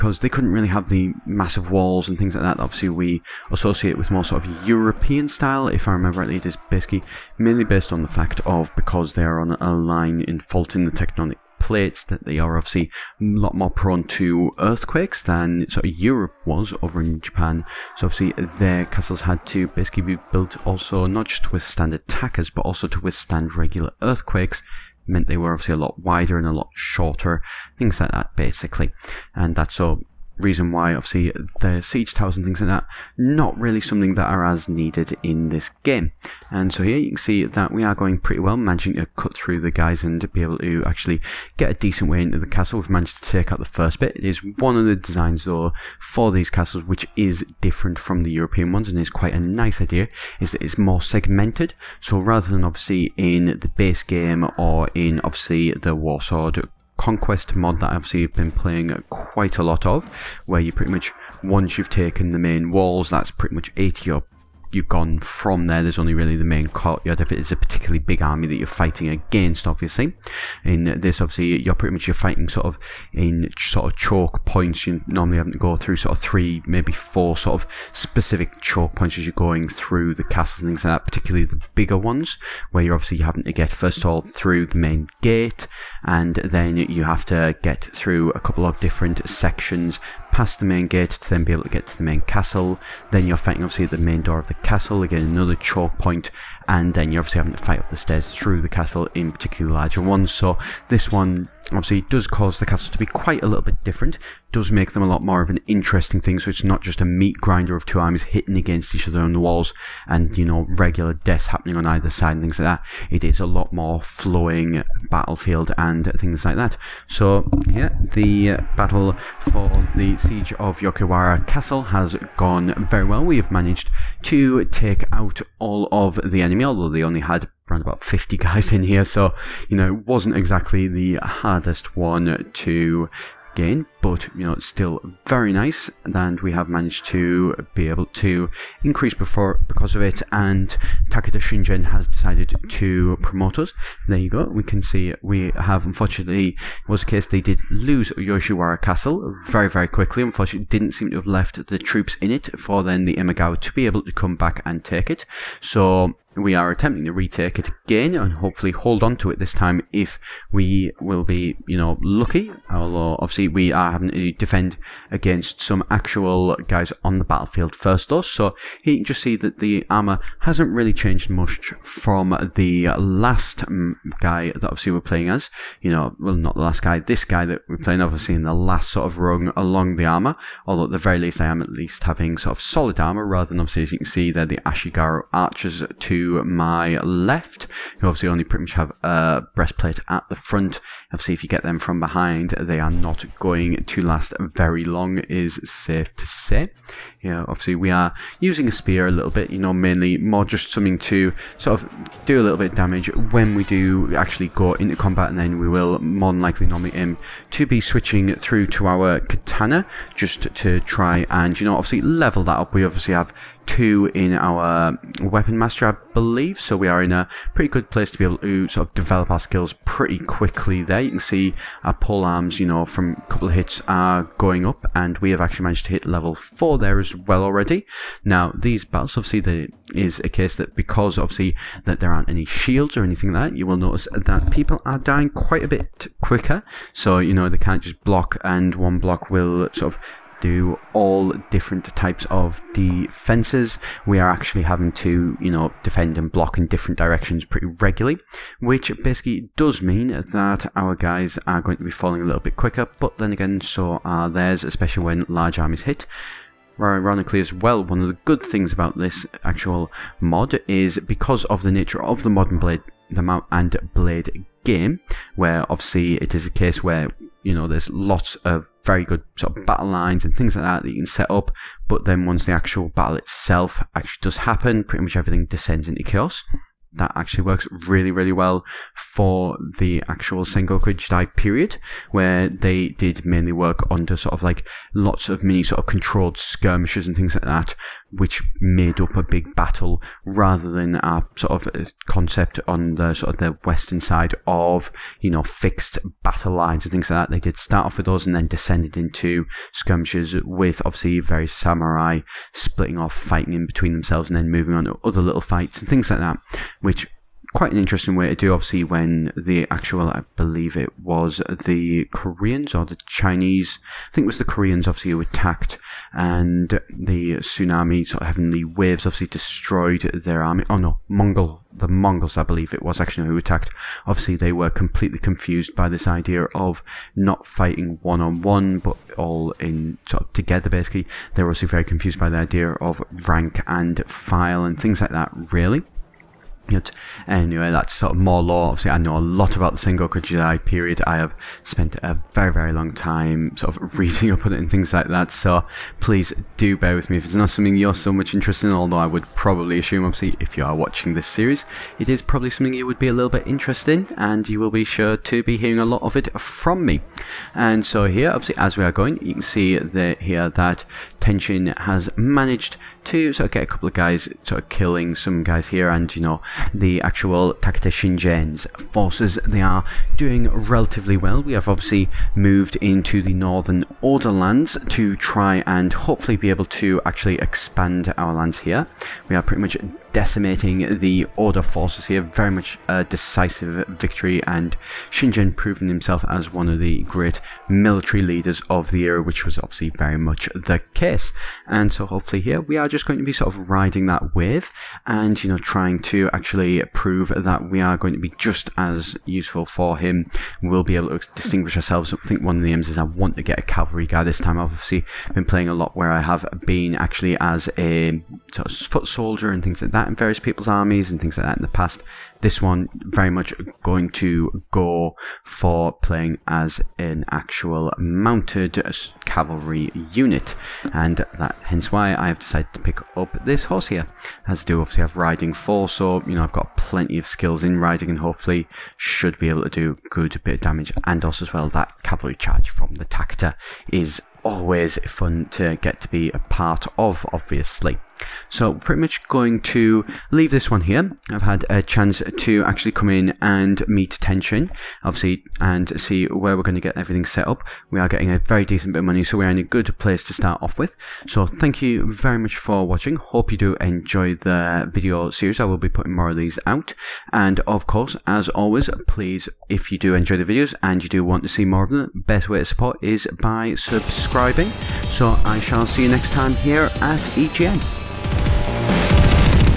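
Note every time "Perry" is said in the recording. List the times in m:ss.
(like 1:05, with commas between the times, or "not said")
not said.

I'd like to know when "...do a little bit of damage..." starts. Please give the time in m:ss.
3:22.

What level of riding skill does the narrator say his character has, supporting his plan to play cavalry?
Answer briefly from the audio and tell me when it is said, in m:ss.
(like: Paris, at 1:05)
4, at 7:05.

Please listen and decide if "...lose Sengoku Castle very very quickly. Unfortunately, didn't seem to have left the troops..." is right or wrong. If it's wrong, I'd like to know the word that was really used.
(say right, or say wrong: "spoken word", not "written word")
wrong: "Yoshiwara", not "Sengoku".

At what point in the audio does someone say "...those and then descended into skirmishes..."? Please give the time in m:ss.
4:58.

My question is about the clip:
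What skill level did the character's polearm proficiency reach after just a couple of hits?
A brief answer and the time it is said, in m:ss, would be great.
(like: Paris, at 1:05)
4, at 3:46.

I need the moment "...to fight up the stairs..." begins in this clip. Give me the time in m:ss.
1:37.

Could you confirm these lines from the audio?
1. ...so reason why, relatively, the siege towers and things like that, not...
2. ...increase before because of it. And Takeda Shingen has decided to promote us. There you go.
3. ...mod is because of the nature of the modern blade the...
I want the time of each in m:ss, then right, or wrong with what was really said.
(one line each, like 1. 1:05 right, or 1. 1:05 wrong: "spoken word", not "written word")
1. 0:29 wrong: "obviously", not "relatively"
2. 2:18 right
3. 4:20 right.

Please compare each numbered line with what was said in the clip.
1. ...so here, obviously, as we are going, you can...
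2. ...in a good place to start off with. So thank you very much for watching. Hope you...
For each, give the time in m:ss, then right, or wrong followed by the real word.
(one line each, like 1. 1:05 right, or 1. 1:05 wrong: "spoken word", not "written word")
1. 5:57 right
2. 7:29 right.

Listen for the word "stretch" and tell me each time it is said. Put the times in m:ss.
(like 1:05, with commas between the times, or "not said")
not said.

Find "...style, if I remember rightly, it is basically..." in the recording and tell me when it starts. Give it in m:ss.
0:05.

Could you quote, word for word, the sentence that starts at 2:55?
You know, well, not the last guy, this guy that we're playing, obviously, in the last sort of rung along the armor.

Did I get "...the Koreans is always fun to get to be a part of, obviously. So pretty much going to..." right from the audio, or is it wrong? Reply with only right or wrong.
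wrong.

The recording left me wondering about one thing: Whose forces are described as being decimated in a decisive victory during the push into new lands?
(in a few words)
the Oda.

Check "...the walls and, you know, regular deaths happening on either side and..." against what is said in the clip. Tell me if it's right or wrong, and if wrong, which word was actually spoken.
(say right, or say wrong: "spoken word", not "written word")
right.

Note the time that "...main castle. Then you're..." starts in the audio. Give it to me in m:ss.
1:32.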